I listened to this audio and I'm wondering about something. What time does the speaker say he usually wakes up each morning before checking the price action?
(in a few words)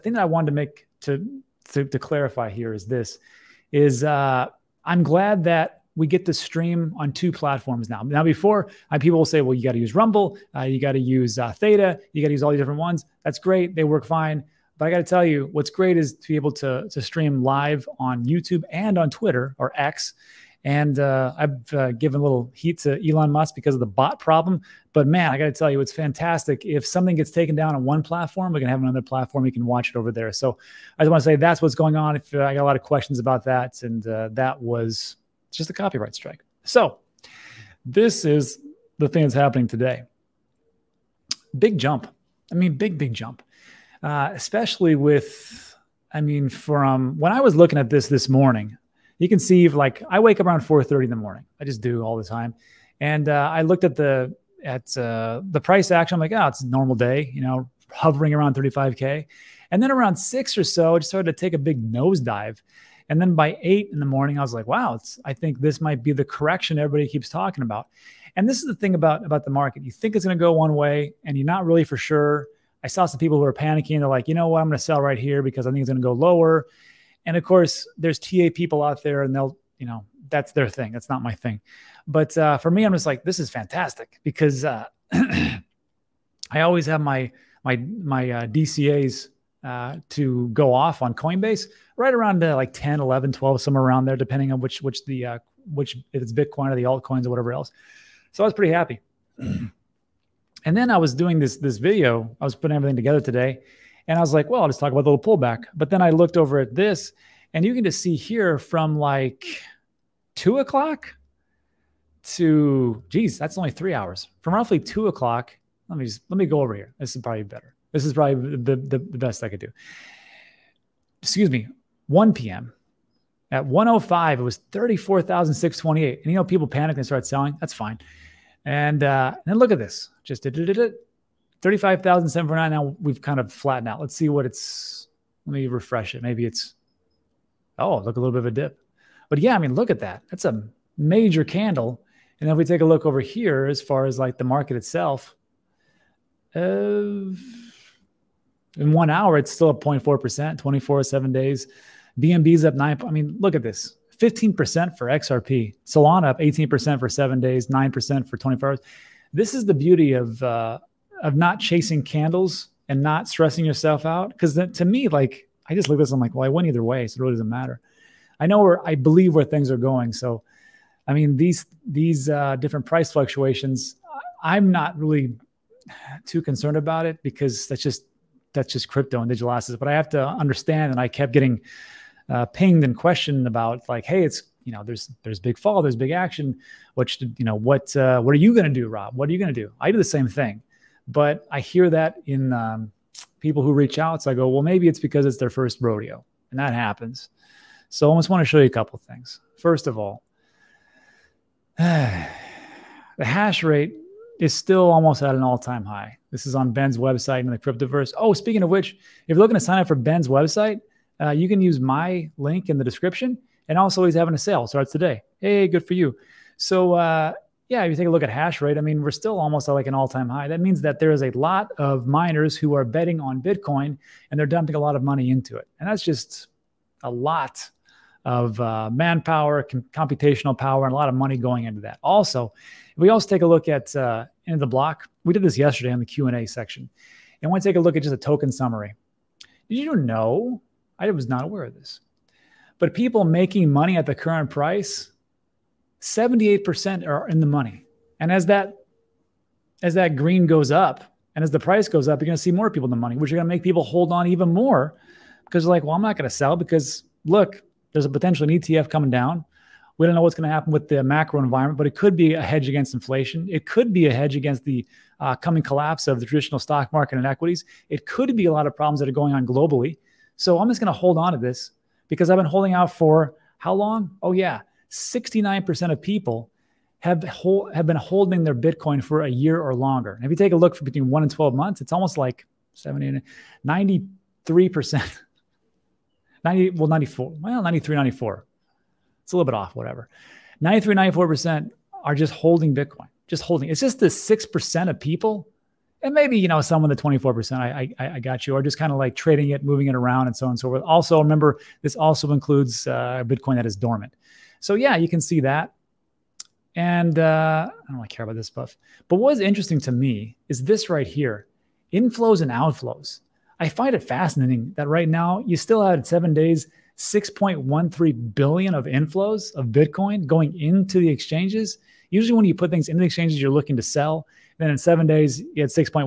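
4:30.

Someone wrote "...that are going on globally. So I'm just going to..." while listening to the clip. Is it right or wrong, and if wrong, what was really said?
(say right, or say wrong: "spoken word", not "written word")
right.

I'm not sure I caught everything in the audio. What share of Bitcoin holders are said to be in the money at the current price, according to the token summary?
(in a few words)
78%.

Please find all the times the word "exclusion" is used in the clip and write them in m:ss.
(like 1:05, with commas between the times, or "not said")
not said.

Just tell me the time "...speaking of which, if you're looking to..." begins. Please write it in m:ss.
3:28.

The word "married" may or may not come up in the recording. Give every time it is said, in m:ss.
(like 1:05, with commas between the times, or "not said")
not said.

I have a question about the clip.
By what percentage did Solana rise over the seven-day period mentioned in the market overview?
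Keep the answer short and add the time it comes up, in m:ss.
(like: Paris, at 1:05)
18%, at 2:36.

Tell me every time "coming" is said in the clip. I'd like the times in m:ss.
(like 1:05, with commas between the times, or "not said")
4:18, 4:25.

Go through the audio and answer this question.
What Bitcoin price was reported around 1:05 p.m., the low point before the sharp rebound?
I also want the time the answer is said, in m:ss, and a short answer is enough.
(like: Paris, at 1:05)
34,628, at 2:04.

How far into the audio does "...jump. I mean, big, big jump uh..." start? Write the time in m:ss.
0:41.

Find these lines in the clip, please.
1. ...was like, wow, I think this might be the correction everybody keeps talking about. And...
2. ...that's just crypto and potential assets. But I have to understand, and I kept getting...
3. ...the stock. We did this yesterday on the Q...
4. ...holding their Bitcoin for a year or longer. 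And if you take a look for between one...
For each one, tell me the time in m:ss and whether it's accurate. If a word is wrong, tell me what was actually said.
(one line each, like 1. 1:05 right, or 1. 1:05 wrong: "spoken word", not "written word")
1. 1:04 right
2. 2:58 wrong: "digital", not "potential"
3. 3:54 wrong: "block", not "stock"
4. 4:37 right.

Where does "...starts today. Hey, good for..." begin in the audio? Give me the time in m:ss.
3:34.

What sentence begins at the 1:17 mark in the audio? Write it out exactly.
And of course, there's TA people out there, and they'll, you know, that's their thing.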